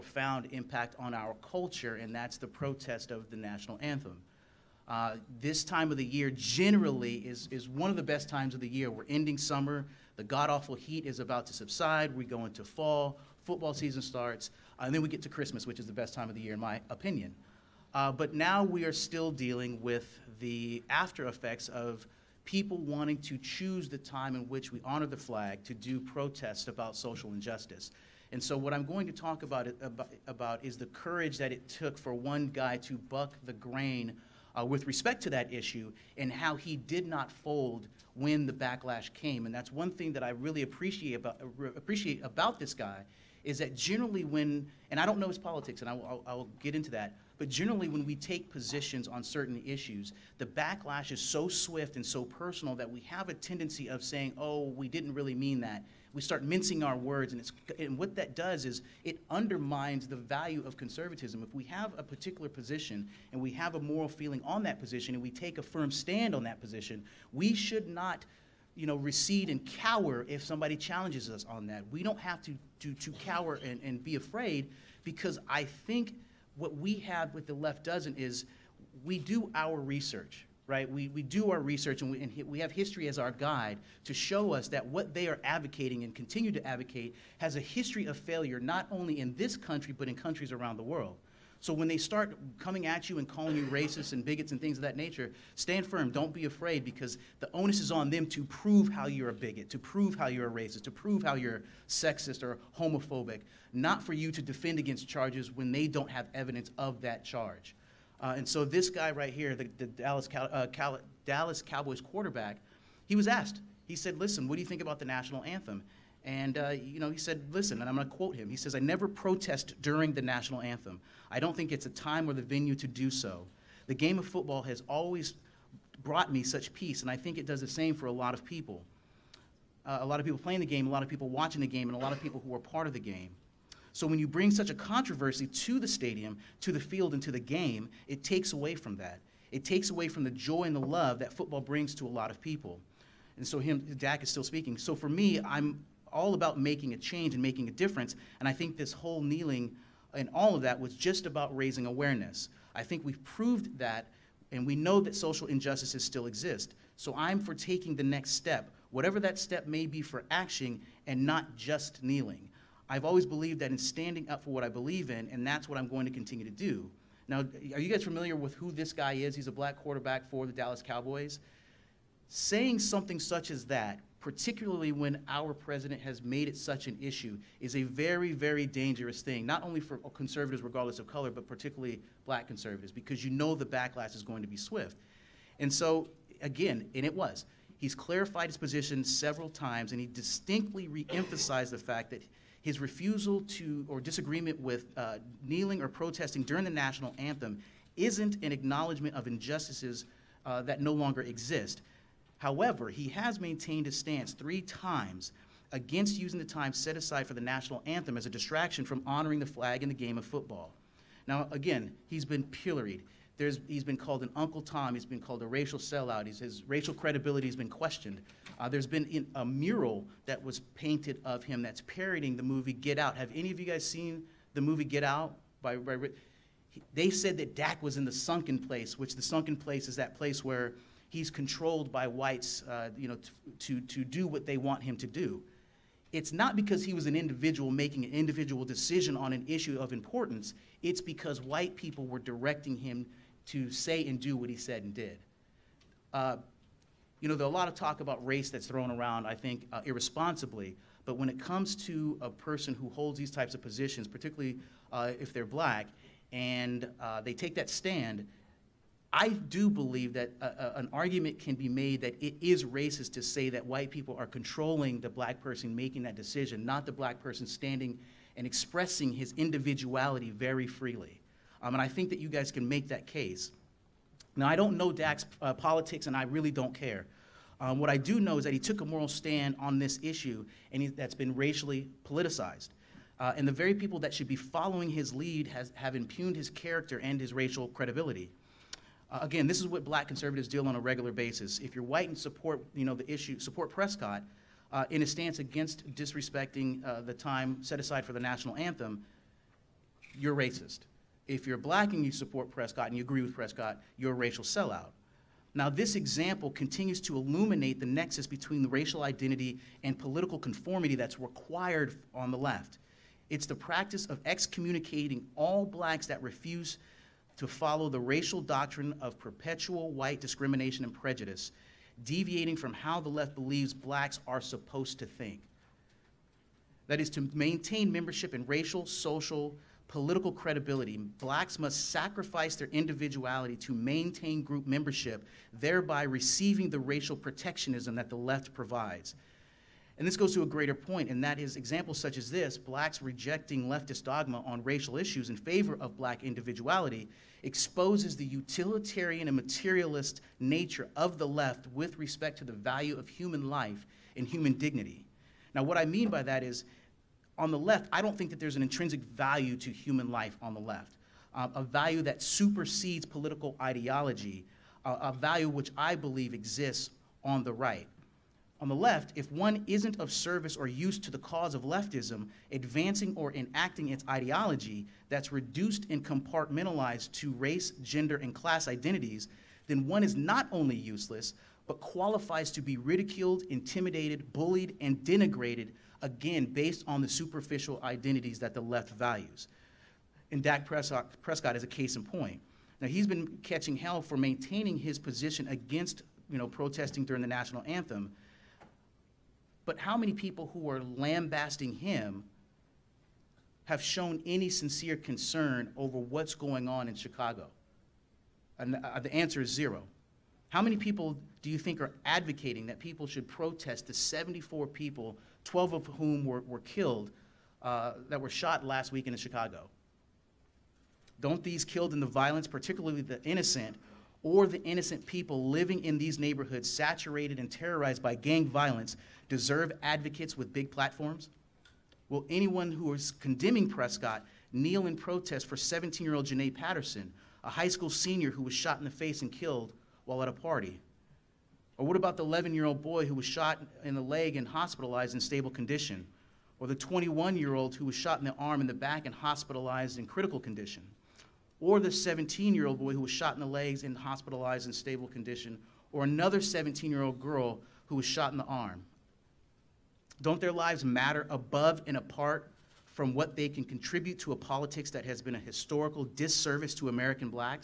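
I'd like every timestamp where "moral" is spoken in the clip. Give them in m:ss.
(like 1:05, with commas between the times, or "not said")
1:03, 4:38.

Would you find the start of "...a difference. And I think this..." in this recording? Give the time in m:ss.
2:27.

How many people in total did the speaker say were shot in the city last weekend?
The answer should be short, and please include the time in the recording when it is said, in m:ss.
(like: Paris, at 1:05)
74, at 6:53.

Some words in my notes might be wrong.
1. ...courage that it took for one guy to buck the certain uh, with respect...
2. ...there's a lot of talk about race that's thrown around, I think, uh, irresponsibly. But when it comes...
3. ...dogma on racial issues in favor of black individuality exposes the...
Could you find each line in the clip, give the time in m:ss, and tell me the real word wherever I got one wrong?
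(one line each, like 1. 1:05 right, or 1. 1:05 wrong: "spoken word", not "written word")
1. 0:30 wrong: "grain", not "certain"
2. 4:07 right
3. 5:44 right.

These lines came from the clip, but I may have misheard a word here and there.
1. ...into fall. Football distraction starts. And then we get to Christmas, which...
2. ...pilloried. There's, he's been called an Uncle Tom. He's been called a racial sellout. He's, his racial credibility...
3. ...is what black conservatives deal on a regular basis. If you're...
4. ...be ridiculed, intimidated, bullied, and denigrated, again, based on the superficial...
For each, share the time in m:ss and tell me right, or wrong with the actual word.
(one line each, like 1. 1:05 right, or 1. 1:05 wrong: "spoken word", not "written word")
1. 0:12 wrong: "season", not "distraction"
2. 3:32 right
3. 4:49 right
4. 6:22 right.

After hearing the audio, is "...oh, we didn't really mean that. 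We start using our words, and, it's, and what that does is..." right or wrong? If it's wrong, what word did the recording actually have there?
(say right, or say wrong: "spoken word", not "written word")
wrong: "mincing", not "using".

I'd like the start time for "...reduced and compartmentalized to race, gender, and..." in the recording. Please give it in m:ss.
6:15.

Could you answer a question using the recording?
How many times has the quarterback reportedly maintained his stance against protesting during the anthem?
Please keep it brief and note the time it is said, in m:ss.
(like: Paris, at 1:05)
3, at 3:24.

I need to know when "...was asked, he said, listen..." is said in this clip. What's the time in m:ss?
1:53.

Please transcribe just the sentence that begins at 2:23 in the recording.
And so him, Dak is still speaking.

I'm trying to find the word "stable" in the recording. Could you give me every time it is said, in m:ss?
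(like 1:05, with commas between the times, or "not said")
7:25, 7:34.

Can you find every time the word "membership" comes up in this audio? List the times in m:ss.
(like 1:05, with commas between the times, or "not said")
5:27, 5:34.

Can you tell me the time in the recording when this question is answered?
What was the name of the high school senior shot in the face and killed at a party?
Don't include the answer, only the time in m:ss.
7:16.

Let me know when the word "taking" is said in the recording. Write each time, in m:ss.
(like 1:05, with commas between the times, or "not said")
2:37.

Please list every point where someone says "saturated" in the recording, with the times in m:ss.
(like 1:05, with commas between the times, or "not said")
7:06.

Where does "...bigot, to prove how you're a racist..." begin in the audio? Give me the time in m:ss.
1:39.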